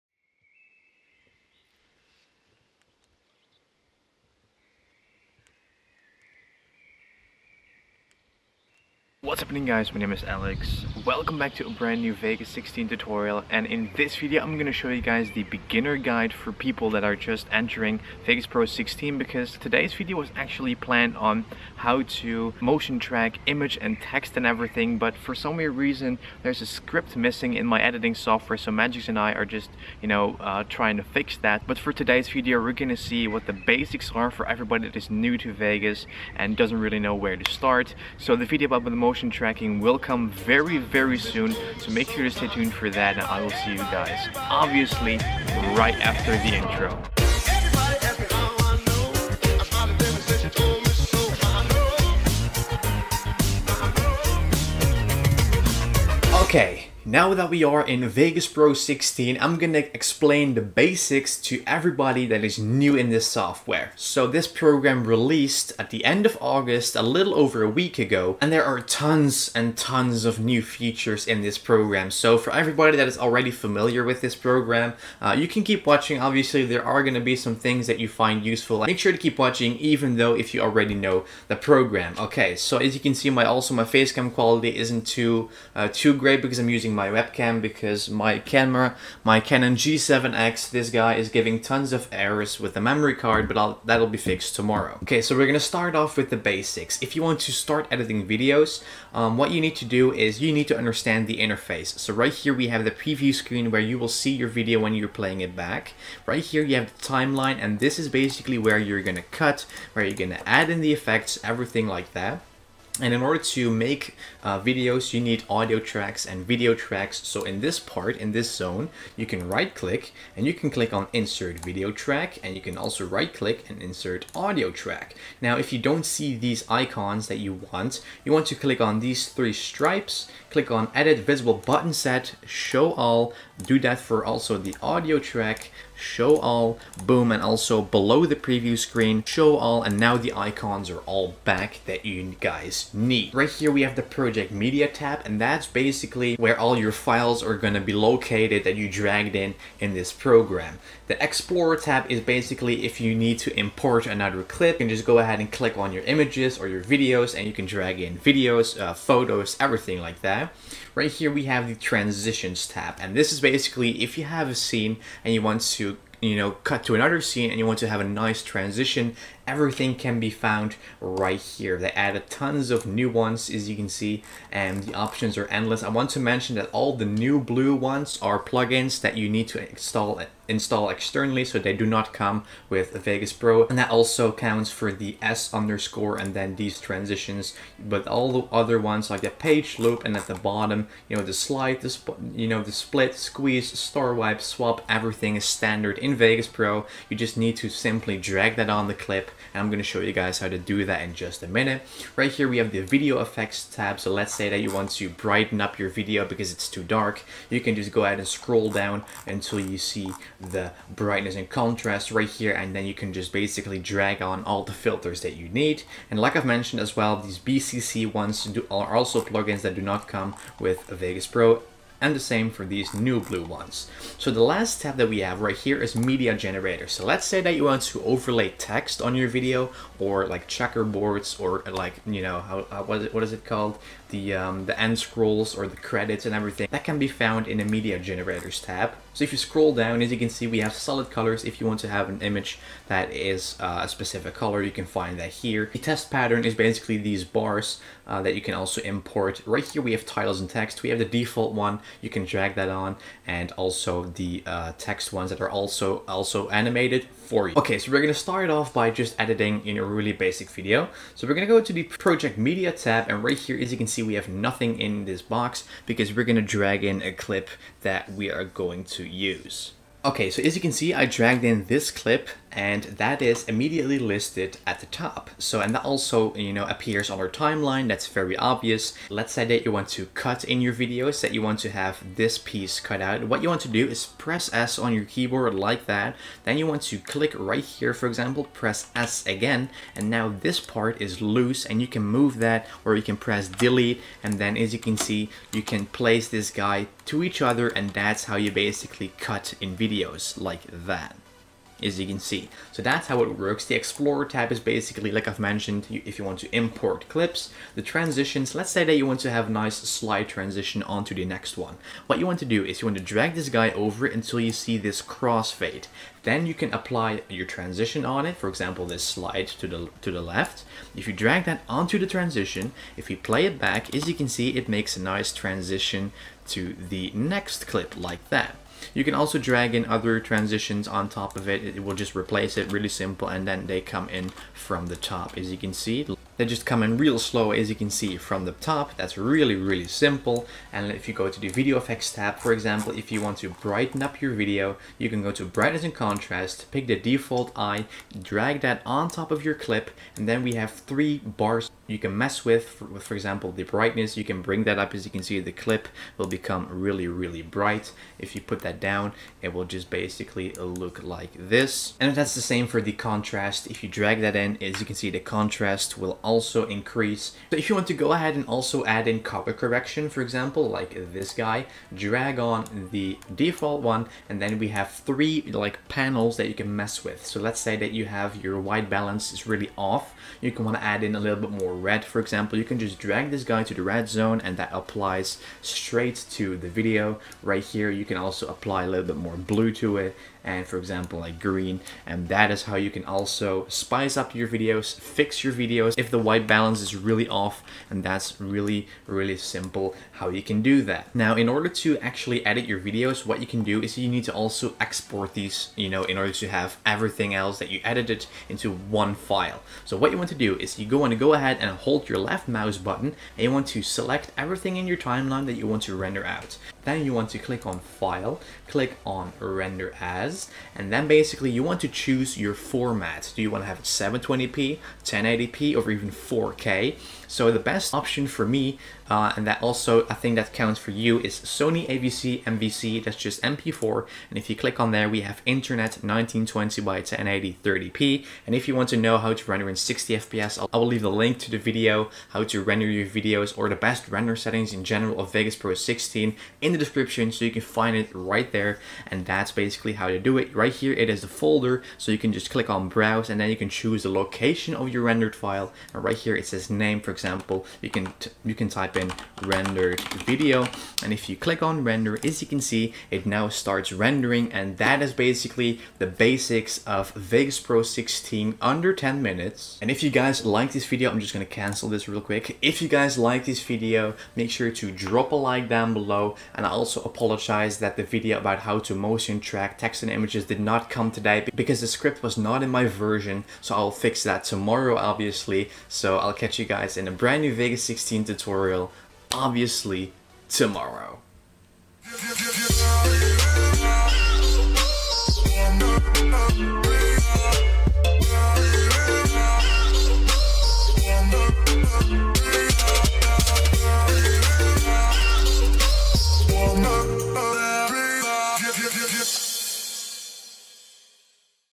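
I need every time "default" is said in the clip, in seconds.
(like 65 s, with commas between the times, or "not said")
251 s, 346 s, 373 s.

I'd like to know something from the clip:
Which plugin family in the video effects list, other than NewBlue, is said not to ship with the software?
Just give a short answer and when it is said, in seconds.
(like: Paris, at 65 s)
BCC, at 217 s.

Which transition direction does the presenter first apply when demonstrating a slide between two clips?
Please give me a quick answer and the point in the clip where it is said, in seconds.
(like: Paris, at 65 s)
to the left, at 320 s.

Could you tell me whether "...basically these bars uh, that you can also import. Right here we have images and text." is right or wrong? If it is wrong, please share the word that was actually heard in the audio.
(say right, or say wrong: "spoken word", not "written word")
wrong: "titles", not "images".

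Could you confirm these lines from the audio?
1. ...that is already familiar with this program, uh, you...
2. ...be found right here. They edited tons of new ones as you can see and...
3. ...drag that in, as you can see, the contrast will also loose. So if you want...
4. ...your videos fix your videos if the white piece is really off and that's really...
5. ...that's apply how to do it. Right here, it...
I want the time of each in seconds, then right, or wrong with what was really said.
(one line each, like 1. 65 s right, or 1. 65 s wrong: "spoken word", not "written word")
1. 72 s right
2. 170 s wrong: "added", not "edited"
3. 363 s wrong: "increase", not "loose"
4. 394 s wrong: "balance", not "piece"
5. 449 s wrong: "basically", not "apply".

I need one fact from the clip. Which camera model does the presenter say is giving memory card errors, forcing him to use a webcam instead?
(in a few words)
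Canon G7X.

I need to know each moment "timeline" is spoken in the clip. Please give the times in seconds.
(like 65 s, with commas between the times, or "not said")
107 s, 277 s, 414 s.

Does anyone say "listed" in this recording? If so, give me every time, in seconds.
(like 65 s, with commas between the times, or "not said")
273 s.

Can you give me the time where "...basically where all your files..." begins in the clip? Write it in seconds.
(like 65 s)
145 s.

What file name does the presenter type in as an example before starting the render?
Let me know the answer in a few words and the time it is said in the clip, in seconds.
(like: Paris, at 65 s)
rendered video, at 459 s.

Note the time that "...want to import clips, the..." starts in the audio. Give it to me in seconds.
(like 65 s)
306 s.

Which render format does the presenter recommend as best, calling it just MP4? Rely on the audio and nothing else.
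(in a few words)
Sony AVC MVC.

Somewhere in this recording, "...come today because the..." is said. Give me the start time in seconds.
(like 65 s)
480 s.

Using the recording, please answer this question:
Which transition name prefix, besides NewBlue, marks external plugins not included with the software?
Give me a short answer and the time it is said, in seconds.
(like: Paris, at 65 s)
S underscore, at 185 s.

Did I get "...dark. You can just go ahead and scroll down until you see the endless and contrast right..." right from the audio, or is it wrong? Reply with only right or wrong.
wrong.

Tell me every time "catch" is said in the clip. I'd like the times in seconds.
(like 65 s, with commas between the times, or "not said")
486 s.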